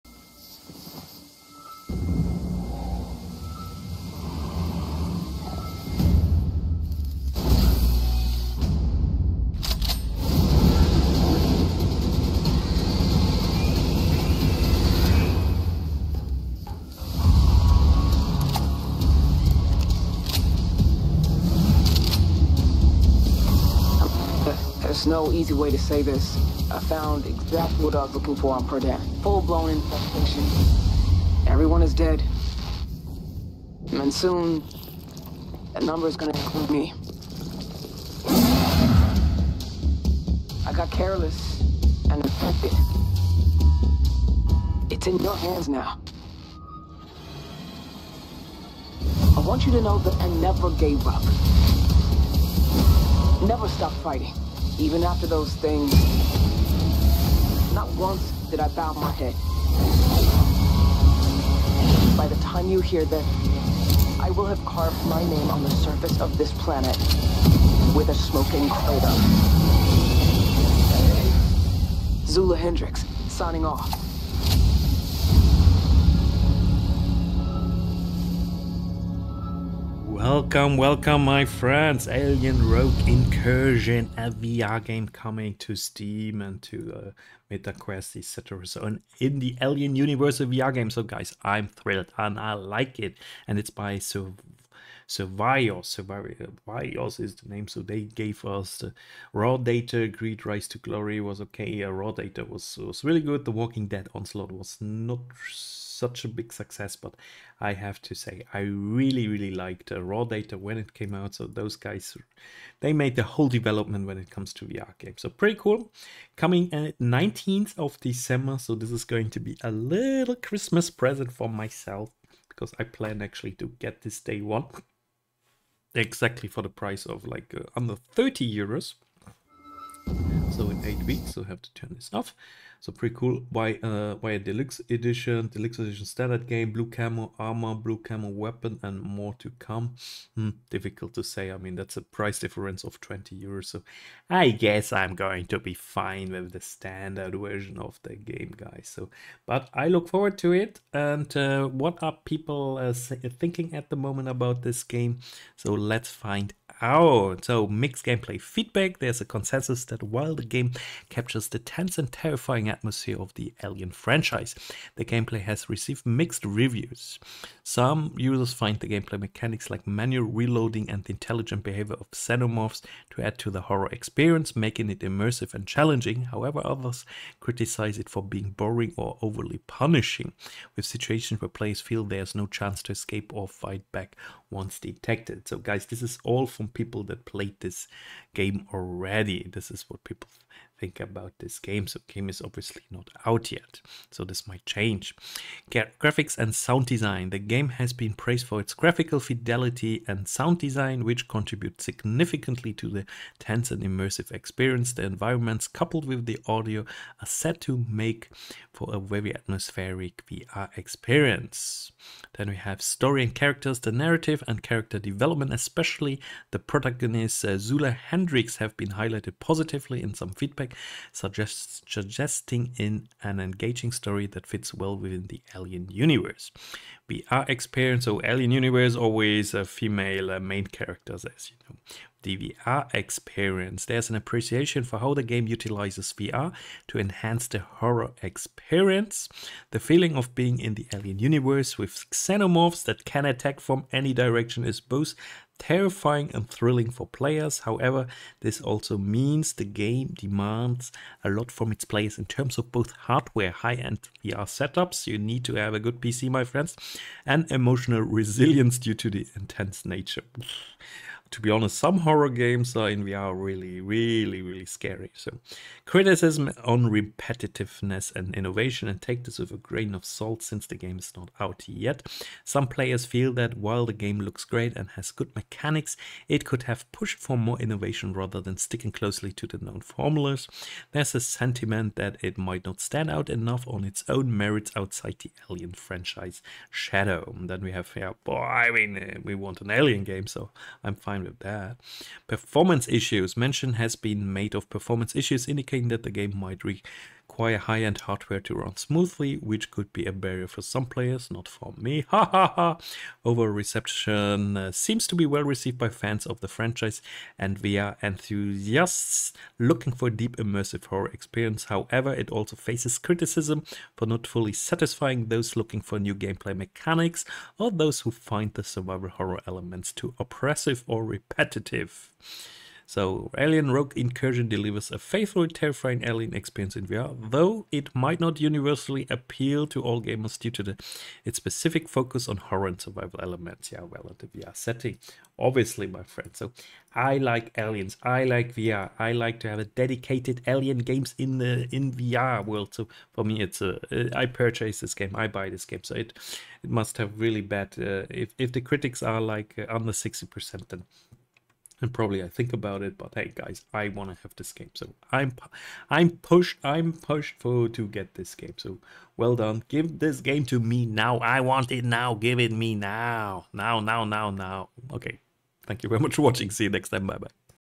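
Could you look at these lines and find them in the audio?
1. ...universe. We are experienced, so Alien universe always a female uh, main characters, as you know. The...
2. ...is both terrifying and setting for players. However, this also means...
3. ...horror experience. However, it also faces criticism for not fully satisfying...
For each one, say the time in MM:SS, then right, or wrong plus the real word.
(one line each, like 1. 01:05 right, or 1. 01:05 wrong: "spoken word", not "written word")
1. 03:45 right
2. 04:04 wrong: "thrilling", not "setting"
3. 05:10 right.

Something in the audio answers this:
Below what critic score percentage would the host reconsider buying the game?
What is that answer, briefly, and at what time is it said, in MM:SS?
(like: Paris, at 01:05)
60 percent, at 05:49.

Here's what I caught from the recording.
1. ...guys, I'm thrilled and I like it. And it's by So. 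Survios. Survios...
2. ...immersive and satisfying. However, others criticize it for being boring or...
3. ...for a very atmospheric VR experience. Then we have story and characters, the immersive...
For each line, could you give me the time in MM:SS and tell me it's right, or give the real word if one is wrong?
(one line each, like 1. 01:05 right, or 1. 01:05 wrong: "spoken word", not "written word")
1. 01:31 right
2. 02:54 wrong: "challenging", not "satisfying"
3. 03:28 wrong: "narrative", not "immersive".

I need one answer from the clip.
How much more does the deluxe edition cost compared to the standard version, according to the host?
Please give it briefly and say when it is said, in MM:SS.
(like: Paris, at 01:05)
20 euros, at 02:22.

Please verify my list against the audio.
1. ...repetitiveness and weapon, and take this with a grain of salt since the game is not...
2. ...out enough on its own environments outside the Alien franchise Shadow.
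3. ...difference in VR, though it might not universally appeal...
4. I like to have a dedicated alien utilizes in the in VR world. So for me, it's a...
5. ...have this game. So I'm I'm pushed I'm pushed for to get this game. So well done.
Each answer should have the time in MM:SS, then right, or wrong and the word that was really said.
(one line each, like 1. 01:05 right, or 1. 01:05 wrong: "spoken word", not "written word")
1. 04:26 wrong: "innovation", not "weapon"
2. 04:43 wrong: "merits", not "environments"
3. 05:26 wrong: "experience", not "difference"
4. 05:38 wrong: "games", not "utilizes"
5. 05:54 right.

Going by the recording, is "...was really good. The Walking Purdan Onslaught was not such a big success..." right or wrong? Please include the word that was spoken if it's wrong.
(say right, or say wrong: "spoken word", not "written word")
wrong: "Dead", not "Purdan".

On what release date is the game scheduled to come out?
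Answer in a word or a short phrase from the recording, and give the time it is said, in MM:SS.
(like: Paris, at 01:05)
19th of December, at 01:56.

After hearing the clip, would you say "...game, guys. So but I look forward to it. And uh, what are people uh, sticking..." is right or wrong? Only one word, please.
wrong.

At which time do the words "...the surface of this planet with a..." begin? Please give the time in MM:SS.
01:05.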